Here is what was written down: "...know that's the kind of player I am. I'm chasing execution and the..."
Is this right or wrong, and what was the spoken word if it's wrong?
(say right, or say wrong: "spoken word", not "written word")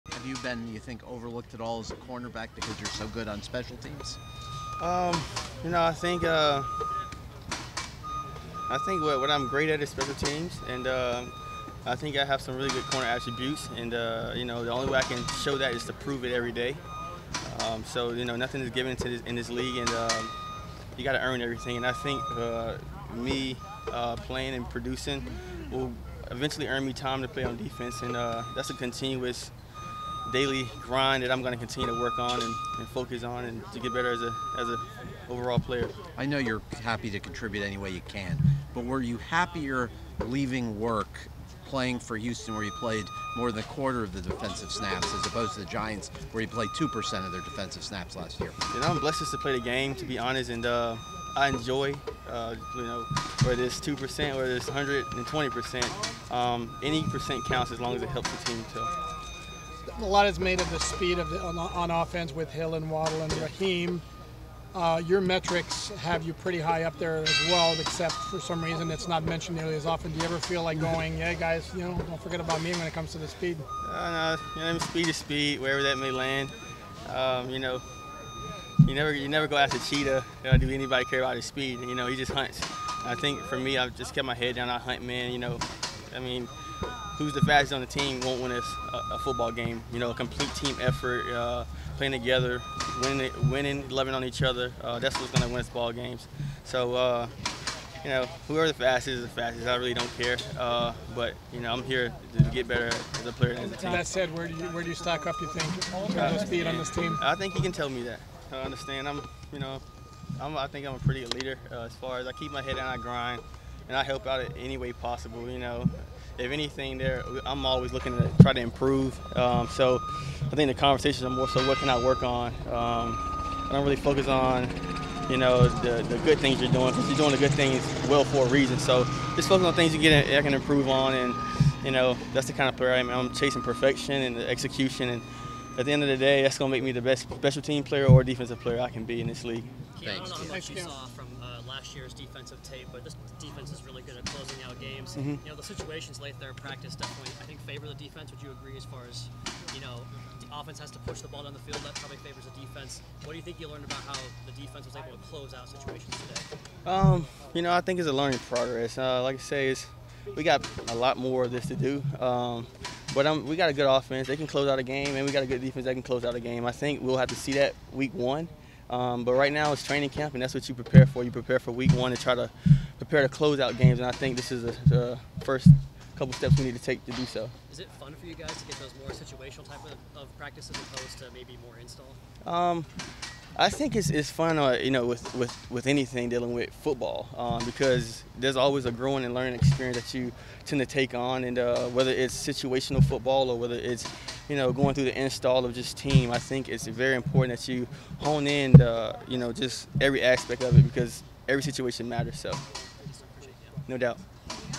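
wrong: "perfection", not "execution".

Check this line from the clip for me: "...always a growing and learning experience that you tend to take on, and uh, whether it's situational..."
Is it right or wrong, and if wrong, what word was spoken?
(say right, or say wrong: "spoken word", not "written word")
right.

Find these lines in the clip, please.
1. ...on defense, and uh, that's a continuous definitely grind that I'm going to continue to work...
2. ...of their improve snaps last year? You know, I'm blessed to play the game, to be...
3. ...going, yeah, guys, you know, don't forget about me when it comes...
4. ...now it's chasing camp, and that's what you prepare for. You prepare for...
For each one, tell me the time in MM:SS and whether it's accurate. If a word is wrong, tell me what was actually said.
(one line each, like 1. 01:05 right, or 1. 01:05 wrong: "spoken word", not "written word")
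1. 00:27 wrong: "daily", not "definitely"
2. 00:47 wrong: "defensive", not "improve"
3. 01:10 right
4. 02:49 wrong: "training", not "chasing".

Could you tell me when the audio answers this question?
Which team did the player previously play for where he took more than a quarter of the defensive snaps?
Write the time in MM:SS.
00:42.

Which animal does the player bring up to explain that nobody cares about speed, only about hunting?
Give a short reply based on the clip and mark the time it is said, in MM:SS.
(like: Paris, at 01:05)
cheetah, at 01:19.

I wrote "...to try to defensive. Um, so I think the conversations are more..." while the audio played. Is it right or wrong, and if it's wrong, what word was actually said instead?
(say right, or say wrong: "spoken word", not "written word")
wrong: "improve", not "defensive".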